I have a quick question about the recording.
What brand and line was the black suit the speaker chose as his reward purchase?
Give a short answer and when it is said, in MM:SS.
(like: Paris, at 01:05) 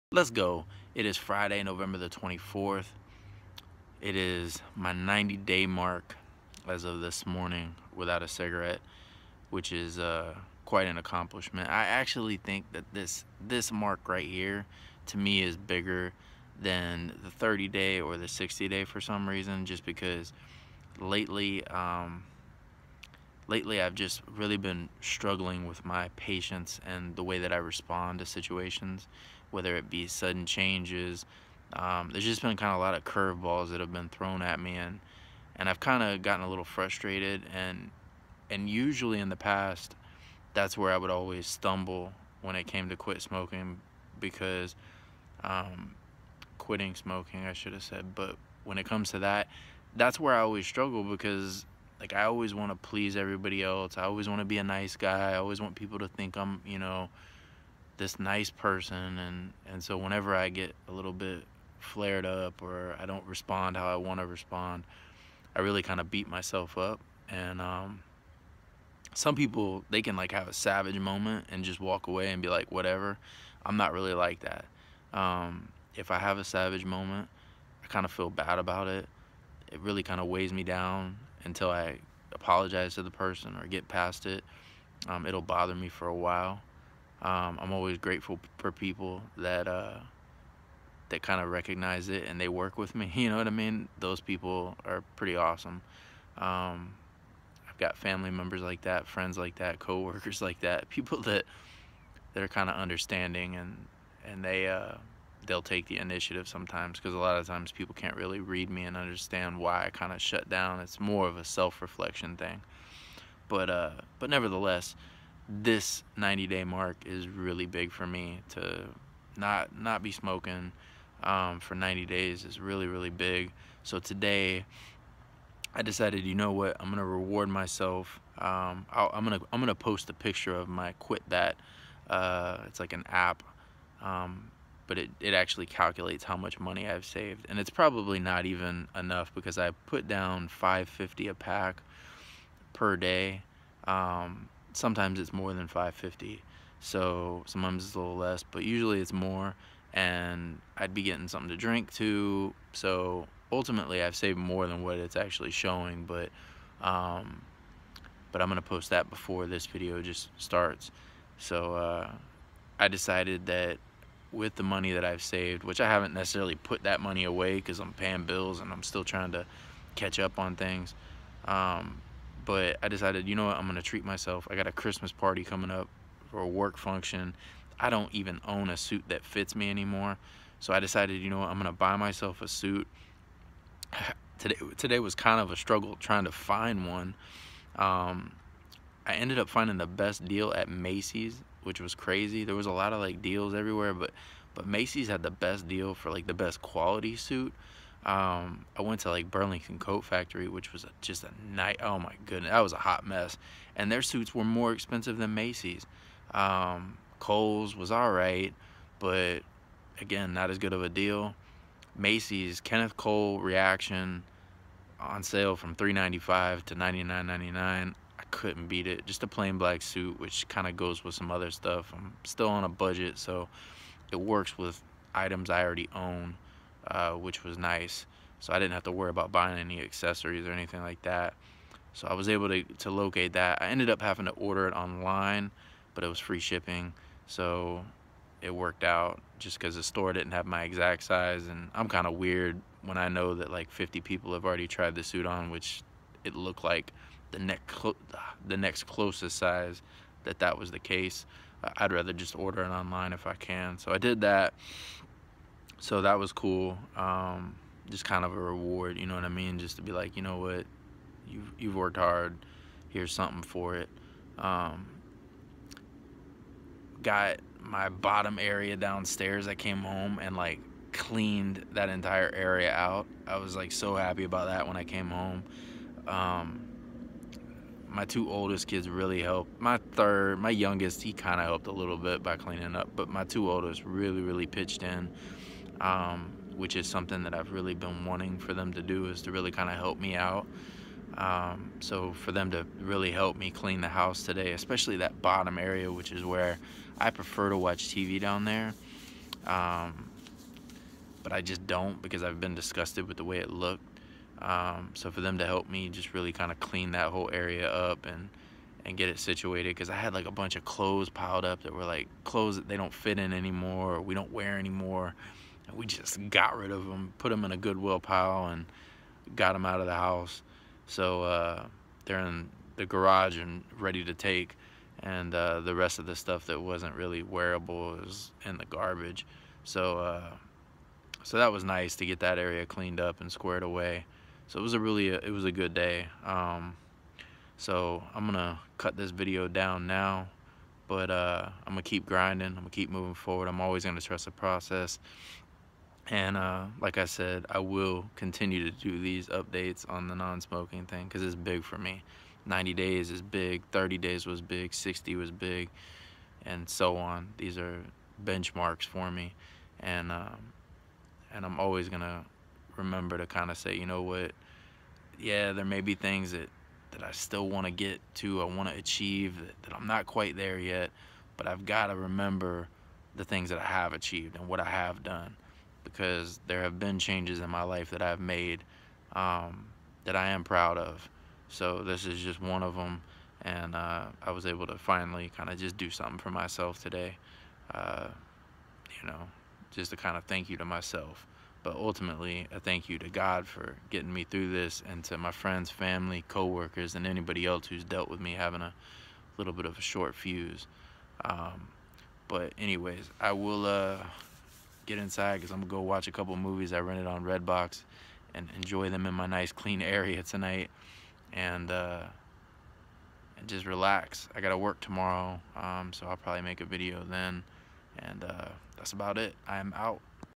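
Kenneth Cole Reaction, at 03:32.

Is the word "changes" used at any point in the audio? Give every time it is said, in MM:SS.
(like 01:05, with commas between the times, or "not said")
00:30, 06:16.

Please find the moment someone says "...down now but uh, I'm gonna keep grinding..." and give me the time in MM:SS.
05:39.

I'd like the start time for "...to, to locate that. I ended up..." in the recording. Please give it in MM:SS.
03:52.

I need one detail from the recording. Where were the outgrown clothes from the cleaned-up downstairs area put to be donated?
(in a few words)
A Goodwill pile.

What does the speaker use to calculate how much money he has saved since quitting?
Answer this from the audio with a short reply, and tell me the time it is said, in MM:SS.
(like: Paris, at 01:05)
An app, at 02:12.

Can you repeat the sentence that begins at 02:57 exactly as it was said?
I don't even own a suit that fits me anymore.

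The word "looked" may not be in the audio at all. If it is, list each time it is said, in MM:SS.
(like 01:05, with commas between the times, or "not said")
04:06, 05:03.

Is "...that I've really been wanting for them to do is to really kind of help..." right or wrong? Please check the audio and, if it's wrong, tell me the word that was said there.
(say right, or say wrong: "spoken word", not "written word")
right.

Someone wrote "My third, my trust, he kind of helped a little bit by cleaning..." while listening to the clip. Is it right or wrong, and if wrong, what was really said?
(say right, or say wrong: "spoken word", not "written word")
wrong: "youngest", not "trust".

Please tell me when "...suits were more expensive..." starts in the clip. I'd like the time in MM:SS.
03:24.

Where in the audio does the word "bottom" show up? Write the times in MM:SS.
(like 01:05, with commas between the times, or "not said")
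04:27, 04:55.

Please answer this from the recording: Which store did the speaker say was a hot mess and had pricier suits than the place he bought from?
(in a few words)
Burlington Coat Factory.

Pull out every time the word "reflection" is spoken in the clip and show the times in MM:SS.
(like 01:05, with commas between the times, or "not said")
01:51.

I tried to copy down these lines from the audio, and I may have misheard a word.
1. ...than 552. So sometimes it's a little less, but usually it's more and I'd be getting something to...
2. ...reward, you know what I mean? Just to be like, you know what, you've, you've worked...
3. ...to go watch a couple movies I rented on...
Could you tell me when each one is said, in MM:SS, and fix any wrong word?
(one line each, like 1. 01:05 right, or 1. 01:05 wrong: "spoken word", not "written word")
1. 02:25 wrong: "550", not "552"
2. 04:18 right
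3. 06:45 right.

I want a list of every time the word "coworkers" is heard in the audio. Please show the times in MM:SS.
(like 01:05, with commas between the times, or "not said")
01:39, 06:36.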